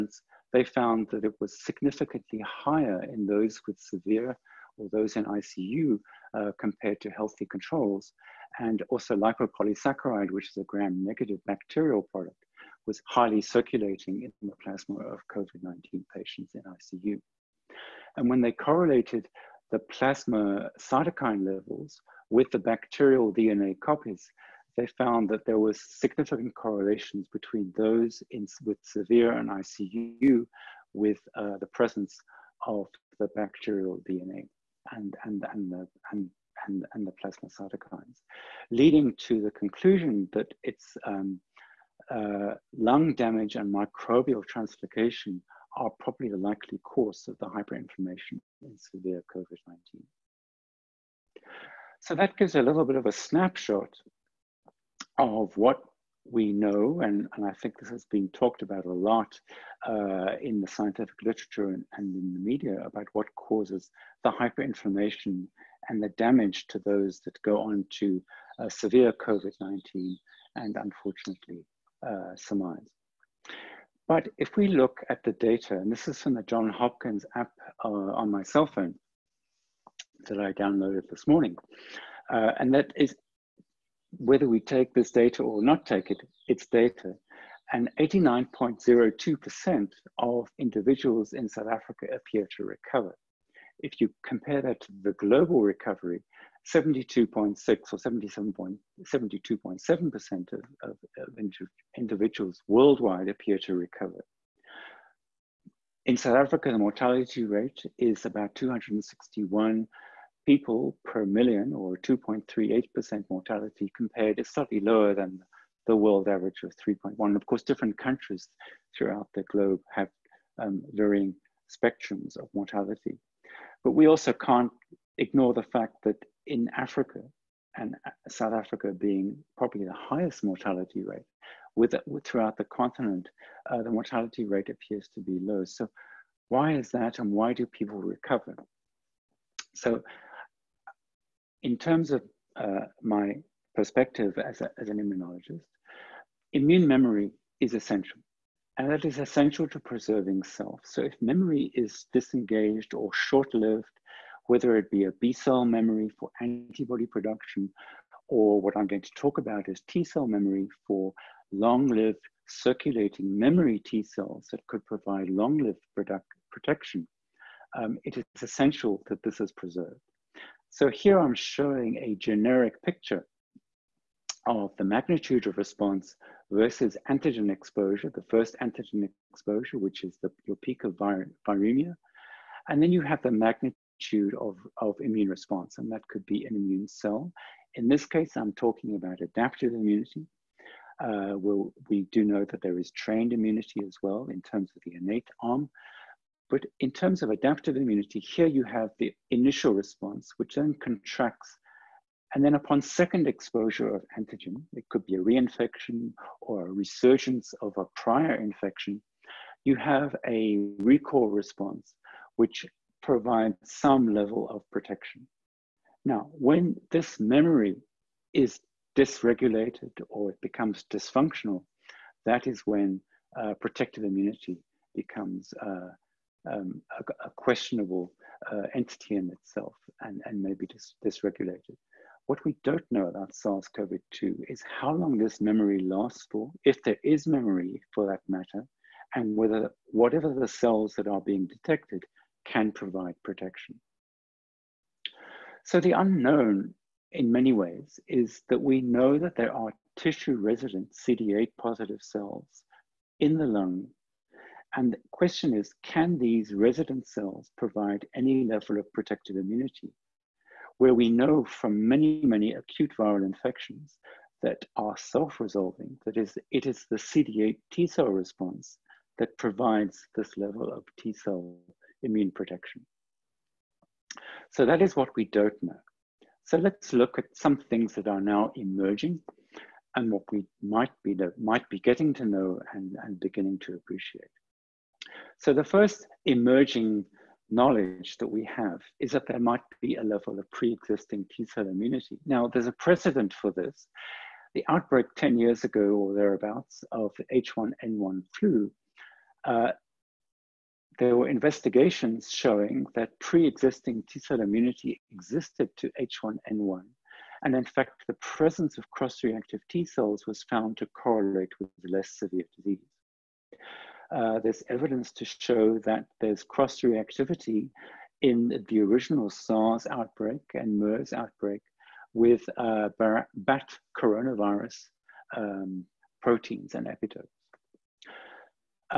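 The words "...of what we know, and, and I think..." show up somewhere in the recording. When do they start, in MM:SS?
00:55.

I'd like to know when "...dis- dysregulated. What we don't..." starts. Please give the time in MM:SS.
03:50.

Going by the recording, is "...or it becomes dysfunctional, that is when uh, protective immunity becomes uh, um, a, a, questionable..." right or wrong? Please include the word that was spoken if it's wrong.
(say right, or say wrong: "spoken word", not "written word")
right.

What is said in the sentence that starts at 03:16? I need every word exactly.
But in terms of adaptive immunity, here you have the initial response, which then contracts.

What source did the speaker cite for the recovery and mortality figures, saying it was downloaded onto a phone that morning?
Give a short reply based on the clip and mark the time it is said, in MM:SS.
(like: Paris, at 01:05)
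John Hopkins app, at 01:16.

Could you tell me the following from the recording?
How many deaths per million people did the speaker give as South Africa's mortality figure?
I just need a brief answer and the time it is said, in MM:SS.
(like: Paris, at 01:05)
261, at 01:48.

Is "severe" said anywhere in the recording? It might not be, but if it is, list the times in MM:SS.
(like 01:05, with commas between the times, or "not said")
00:03, 00:28, 00:48, 01:08, 05:12.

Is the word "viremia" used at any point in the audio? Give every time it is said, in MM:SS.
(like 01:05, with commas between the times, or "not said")
03:01.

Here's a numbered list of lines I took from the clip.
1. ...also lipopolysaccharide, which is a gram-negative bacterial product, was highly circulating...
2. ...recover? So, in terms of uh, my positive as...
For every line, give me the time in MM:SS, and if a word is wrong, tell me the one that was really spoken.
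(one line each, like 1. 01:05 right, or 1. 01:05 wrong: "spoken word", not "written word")
1. 00:08 right
2. 02:17 wrong: "perspective", not "positive".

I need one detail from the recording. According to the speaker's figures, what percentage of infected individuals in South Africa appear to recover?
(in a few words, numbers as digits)
89.02%.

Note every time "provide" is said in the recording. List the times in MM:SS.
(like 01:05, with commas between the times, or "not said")
02:44, 03:33, 04:02, 04:17, 04:29.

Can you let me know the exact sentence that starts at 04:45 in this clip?
So the first emerging knowledge that we have is that there might be a level of pre-existing T-cell immunity.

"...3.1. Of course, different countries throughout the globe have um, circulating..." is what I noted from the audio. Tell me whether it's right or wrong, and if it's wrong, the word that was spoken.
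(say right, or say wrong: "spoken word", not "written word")
wrong: "varying", not "circulating".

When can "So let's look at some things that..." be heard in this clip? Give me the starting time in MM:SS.
04:36.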